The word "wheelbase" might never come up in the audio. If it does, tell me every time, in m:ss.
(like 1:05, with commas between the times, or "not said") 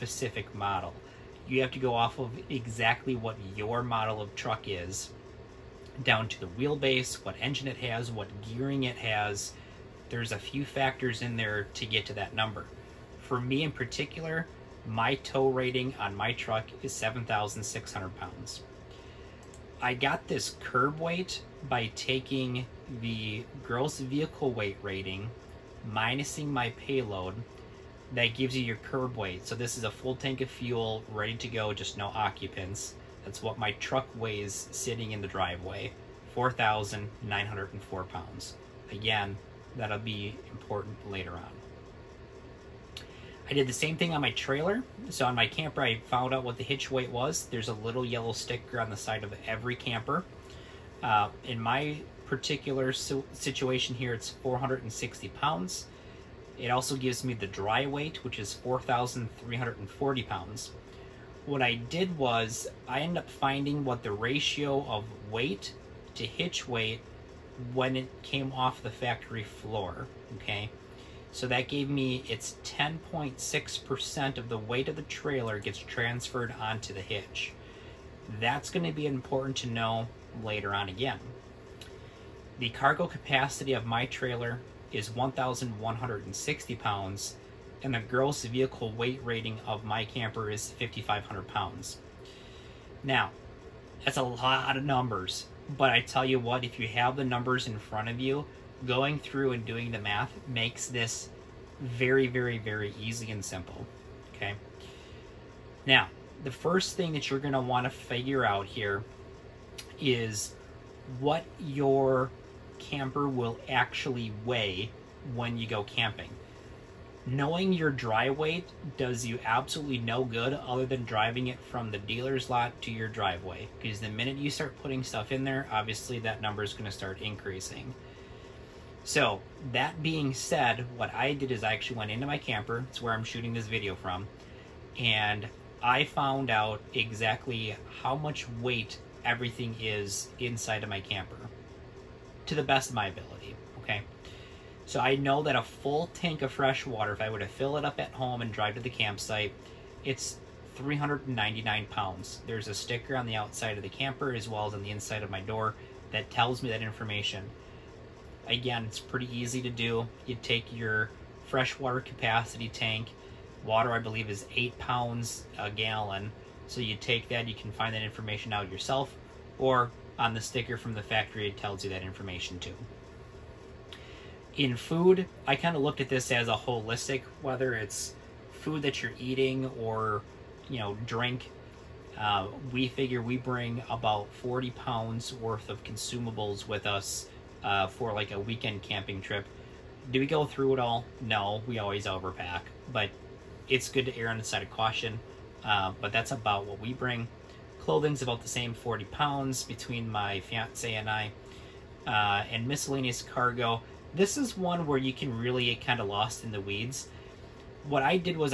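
0:06.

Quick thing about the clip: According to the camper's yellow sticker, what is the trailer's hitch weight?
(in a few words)
460 pounds.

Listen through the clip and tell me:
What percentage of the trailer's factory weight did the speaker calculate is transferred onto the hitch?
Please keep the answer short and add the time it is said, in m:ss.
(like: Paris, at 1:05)
10.6%, at 1:12.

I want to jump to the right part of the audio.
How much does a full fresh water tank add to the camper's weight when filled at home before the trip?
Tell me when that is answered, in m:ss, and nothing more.
2:30.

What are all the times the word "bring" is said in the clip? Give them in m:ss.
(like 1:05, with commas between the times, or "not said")
3:03, 3:16.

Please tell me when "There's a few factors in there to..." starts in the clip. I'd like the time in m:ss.
0:10.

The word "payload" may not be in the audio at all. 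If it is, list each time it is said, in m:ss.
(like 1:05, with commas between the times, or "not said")
0:26.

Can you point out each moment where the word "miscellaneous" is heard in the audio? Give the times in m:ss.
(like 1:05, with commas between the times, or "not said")
3:22.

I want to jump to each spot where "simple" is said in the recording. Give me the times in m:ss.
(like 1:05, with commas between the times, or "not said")
1:43.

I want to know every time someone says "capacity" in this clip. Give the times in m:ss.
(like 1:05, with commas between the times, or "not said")
1:23, 2:41.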